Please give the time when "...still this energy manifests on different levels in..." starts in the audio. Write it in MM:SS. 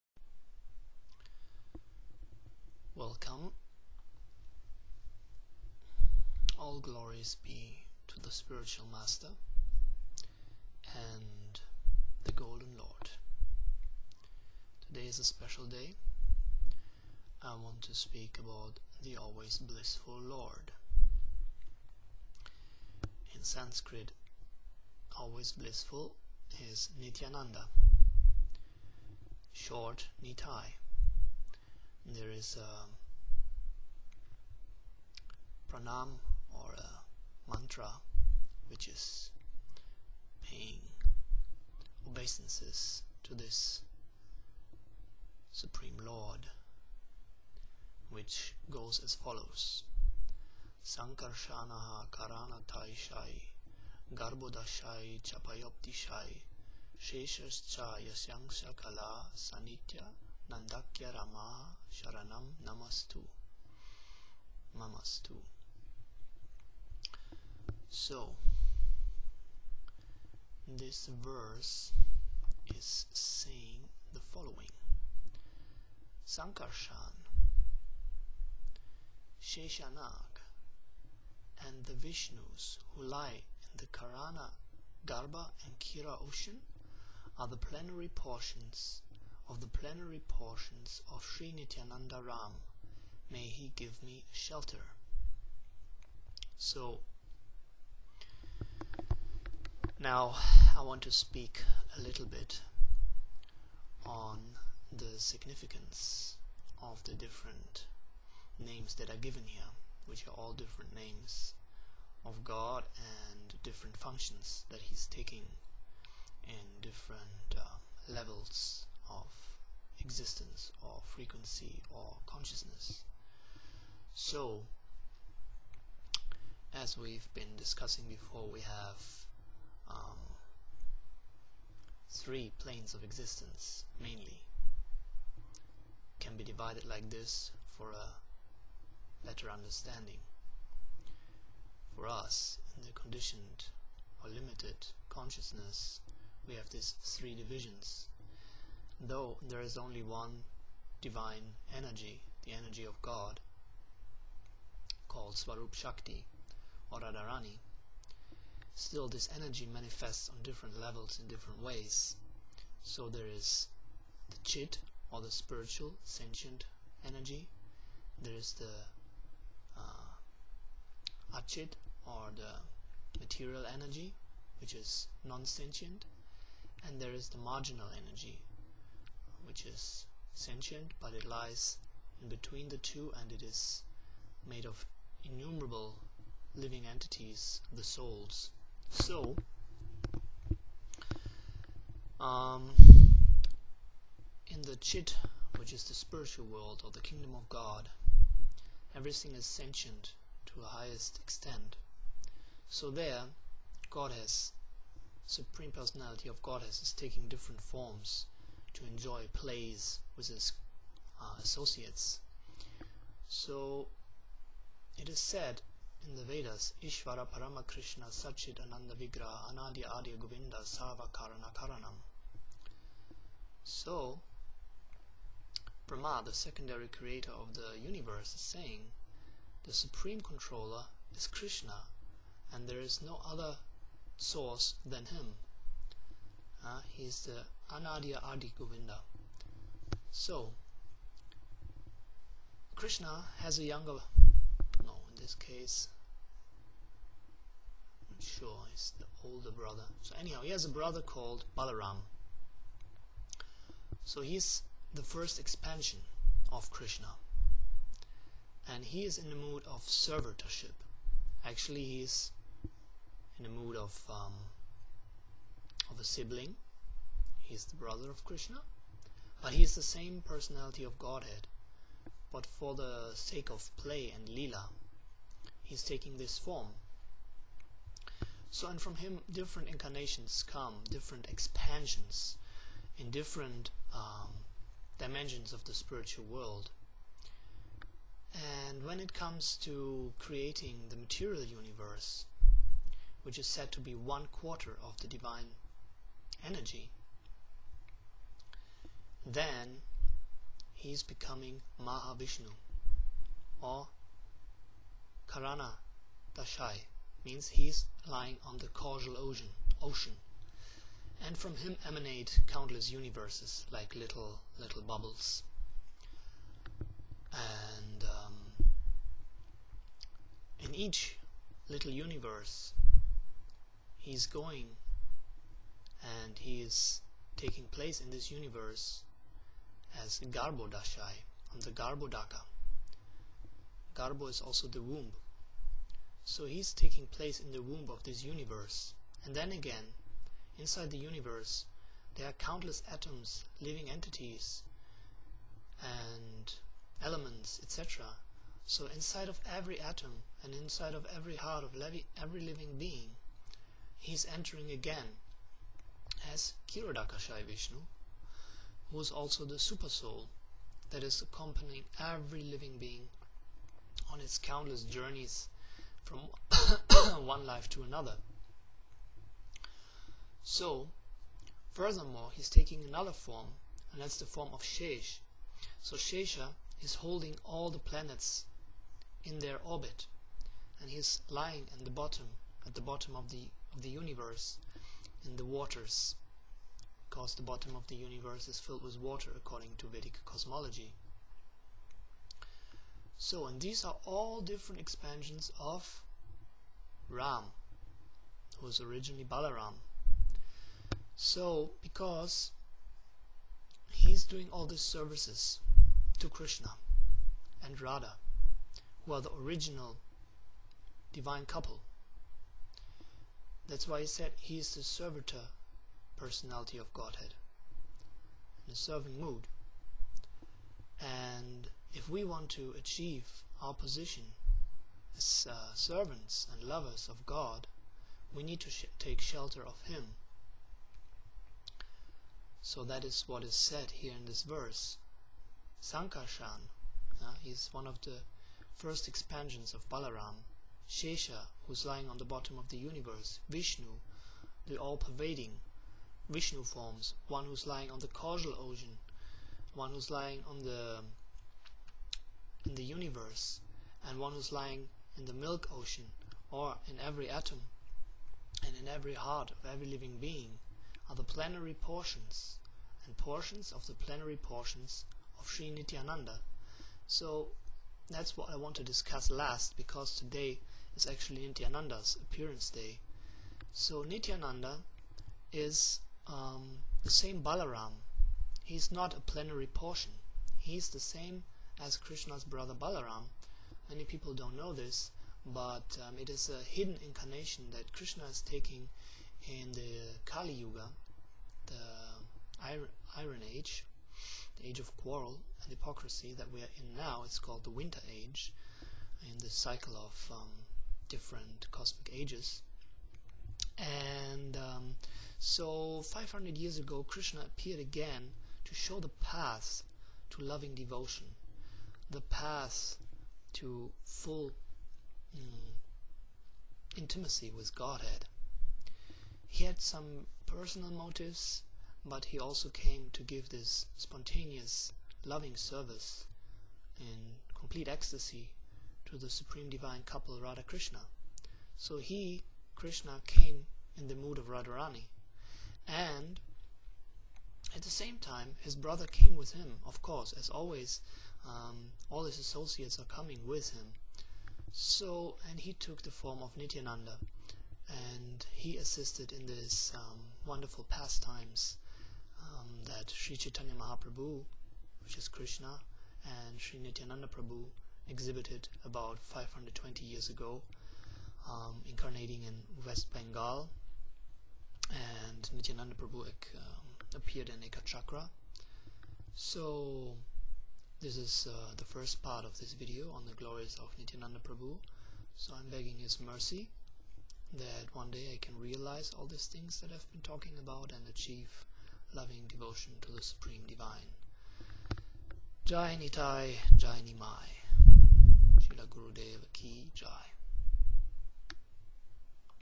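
02:38.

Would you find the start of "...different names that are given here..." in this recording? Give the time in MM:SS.
01:47.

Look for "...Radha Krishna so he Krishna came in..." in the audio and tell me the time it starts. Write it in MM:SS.
08:50.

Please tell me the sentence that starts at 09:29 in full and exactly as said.
So this is uh, the first part of this video on the glories of Nityananda Prabhu.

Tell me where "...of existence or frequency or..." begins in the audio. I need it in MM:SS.
01:59.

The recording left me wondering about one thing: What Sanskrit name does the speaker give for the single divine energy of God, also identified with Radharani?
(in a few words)
Swarup Shakti.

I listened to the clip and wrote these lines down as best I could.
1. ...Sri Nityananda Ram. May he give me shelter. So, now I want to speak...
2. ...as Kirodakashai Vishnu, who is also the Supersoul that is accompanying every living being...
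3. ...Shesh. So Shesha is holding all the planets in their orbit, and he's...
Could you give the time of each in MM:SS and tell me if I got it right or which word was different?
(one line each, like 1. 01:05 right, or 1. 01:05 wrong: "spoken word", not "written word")
1. 01:31 right
2. 05:56 right
3. 06:14 right.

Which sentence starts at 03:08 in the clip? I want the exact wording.
So, um, in the chit, which is the spiritual world or the kingdom of God, everything is sentient to the highest extent.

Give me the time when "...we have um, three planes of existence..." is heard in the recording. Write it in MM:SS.
02:08.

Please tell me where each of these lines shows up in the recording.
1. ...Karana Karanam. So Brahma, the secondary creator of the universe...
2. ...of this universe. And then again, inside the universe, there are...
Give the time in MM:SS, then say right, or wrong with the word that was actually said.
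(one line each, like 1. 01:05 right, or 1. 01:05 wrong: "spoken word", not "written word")
1. 03:41 right
2. 05:37 right.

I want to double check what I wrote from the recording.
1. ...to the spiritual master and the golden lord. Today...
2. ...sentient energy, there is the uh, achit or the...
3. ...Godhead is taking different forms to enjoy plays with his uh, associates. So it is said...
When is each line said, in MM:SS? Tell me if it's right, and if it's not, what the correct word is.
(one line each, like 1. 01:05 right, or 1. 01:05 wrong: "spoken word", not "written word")
1. 00:08 right
2. 02:46 right
3. 03:26 right.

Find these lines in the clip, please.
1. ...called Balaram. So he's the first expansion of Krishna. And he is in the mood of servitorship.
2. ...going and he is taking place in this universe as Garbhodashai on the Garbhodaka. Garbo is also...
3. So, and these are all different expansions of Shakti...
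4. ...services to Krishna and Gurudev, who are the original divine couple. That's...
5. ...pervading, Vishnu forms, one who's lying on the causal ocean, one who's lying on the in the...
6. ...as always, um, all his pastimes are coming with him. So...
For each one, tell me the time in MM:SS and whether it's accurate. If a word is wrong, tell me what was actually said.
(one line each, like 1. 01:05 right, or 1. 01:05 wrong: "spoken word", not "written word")
1. 04:11 right
2. 05:24 right
3. 06:33 wrong: "Ram", not "Shakti"
4. 06:44 wrong: "Radha", not "Gurudev"
5. 07:24 right
6. 09:00 wrong: "associates", not "pastimes".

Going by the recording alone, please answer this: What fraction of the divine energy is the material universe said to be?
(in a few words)
One quarter.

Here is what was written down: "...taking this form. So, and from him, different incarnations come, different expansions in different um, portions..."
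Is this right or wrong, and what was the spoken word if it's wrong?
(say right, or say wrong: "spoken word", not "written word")
wrong: "dimensions", not "portions".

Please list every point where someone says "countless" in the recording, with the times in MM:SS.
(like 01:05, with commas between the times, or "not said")
05:12, 05:42, 06:04.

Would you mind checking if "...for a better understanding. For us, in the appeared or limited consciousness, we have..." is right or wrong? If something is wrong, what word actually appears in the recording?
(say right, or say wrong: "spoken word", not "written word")
wrong: "conditioned", not "appeared".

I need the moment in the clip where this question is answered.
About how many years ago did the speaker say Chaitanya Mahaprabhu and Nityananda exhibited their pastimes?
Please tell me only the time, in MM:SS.
09:19.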